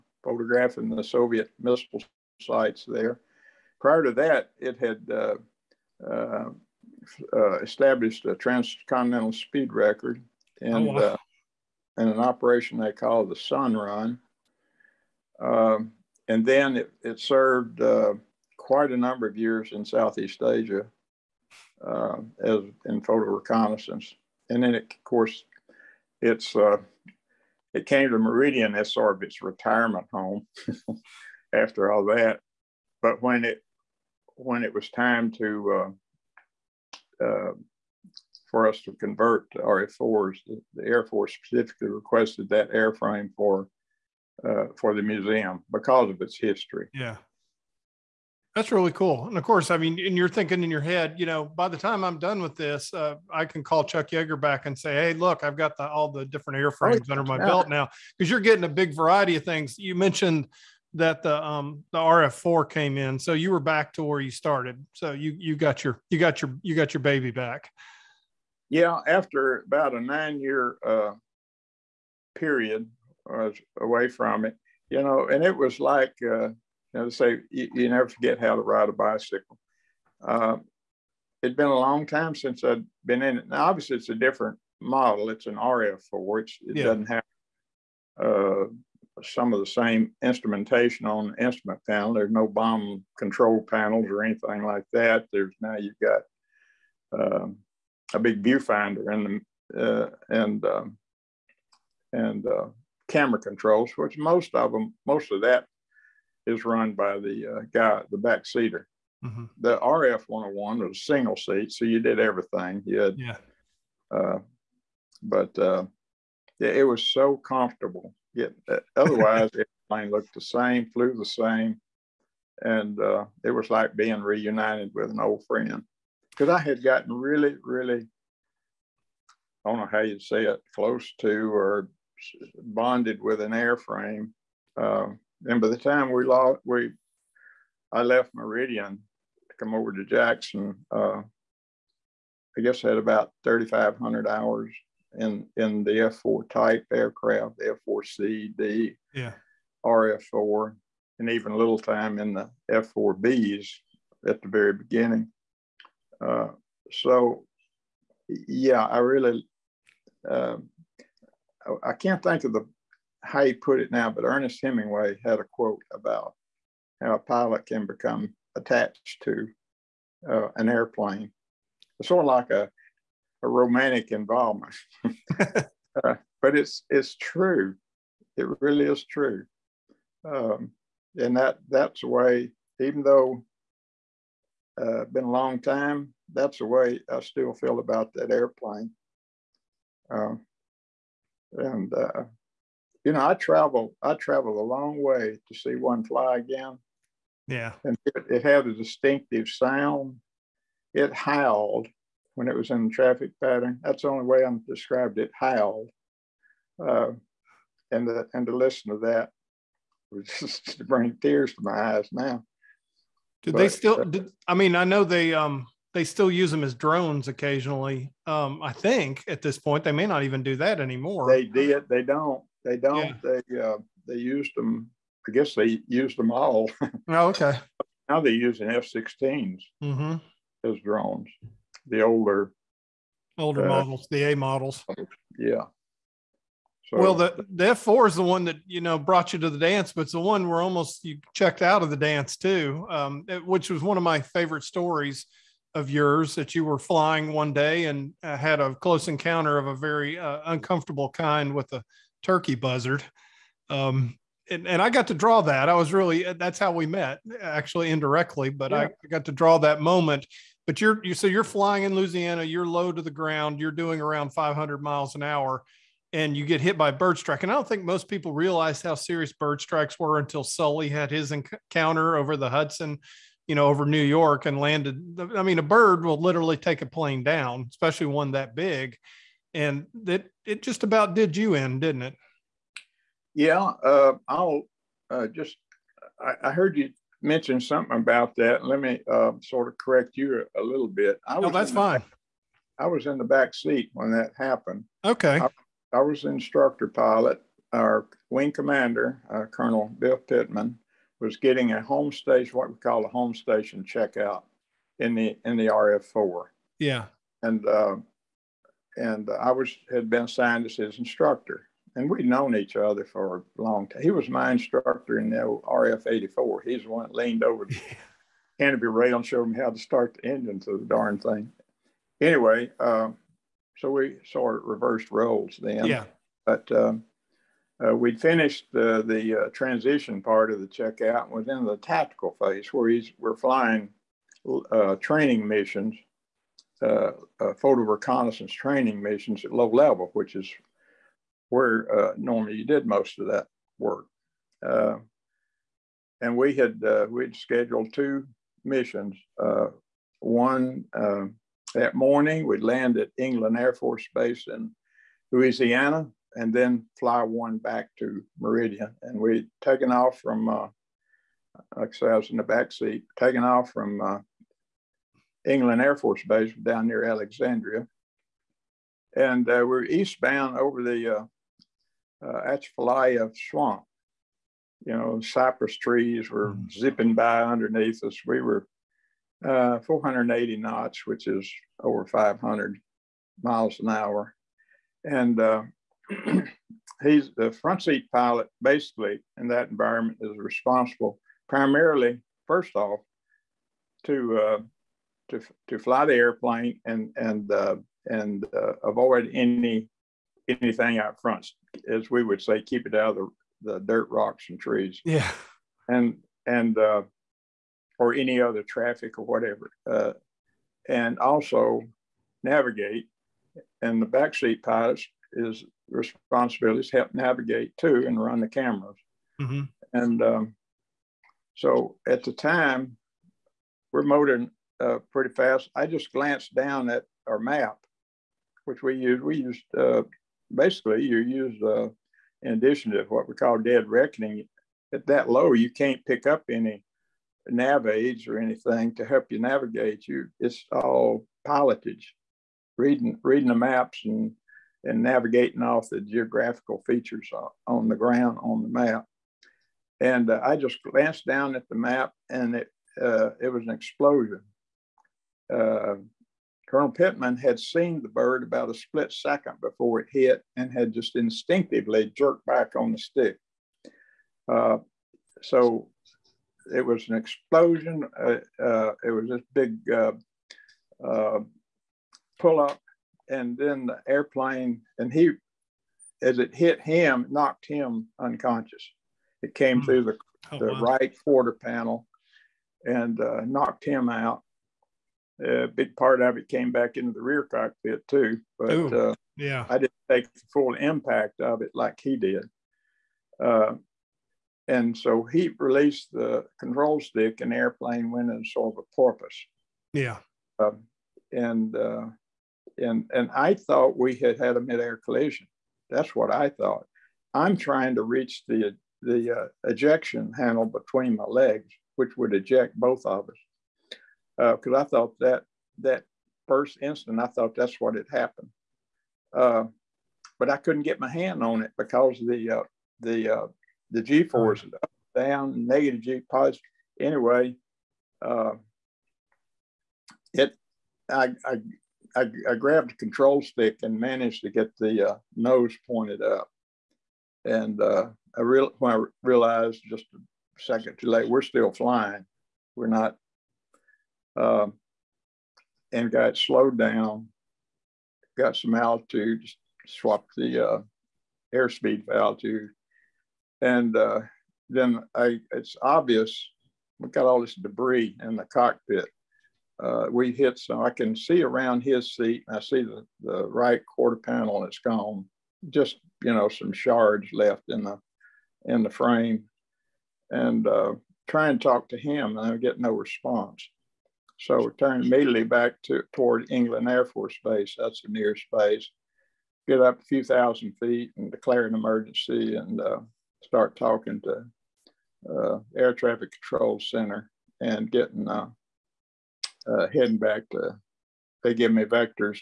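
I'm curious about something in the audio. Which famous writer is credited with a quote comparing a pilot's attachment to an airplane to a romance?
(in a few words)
Ernest Hemingway.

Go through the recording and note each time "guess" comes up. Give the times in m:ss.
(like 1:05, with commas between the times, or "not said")
2:22, 3:45.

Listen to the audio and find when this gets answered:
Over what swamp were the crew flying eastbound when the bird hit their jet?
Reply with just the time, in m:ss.
6:12.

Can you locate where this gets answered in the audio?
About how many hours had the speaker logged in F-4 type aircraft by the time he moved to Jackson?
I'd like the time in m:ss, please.
2:23.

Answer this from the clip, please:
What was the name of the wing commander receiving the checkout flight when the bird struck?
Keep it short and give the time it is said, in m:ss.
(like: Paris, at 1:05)
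Bill Pittman, at 4:59.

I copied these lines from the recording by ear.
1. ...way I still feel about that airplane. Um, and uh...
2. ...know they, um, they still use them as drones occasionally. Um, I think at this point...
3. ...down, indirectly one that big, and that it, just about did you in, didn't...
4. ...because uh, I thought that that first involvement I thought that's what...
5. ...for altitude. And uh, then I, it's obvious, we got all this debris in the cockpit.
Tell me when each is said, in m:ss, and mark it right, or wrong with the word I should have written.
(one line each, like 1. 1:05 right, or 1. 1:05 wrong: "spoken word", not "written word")
1. 3:06 right
2. 3:34 right
3. 4:37 wrong: "especially", not "indirectly"
4. 8:34 wrong: "instant", not "involvement"
5. 9:12 right.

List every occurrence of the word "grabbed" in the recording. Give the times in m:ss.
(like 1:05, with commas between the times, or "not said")
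8:52.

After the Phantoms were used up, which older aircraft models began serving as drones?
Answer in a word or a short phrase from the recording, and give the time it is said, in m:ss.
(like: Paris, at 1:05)
F-16 A models, at 3:48.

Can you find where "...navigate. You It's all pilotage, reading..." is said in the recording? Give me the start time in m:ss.
7:19.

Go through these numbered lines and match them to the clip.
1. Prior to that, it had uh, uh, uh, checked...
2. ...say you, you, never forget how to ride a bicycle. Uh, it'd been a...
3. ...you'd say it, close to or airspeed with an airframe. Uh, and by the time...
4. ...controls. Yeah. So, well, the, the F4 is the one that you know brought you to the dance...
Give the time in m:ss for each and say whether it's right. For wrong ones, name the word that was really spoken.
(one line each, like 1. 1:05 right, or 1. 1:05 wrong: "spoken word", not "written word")
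1. 0:03 wrong: "established", not "checked"
2. 1:17 right
3. 2:09 wrong: "bonded", not "airspeed"
4. 3:54 wrong: "models", not "controls".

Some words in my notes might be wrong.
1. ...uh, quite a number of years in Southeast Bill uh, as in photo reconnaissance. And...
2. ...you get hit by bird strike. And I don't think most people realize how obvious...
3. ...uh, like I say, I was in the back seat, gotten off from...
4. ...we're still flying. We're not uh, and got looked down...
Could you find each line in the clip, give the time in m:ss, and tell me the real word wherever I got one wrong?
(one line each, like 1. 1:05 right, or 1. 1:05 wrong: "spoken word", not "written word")
1. 0:17 wrong: "Asia", not "Bill"
2. 4:26 wrong: "serious", not "obvious"
3. 6:00 wrong: "taken", not "gotten"
4. 9:01 wrong: "slowed", not "looked".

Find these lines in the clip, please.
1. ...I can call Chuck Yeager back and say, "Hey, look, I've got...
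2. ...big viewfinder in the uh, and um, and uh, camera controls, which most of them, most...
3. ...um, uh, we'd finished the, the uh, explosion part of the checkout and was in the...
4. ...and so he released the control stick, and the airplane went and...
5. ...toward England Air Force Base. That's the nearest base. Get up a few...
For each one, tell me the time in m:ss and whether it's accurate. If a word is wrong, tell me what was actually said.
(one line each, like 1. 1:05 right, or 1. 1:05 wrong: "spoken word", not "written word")
1. 0:53 right
2. 1:38 right
3. 5:26 wrong: "transition", not "explosion"
4. 8:14 right
5. 9:36 right.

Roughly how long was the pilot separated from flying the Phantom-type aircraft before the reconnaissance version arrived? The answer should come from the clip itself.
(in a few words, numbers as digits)
9 years.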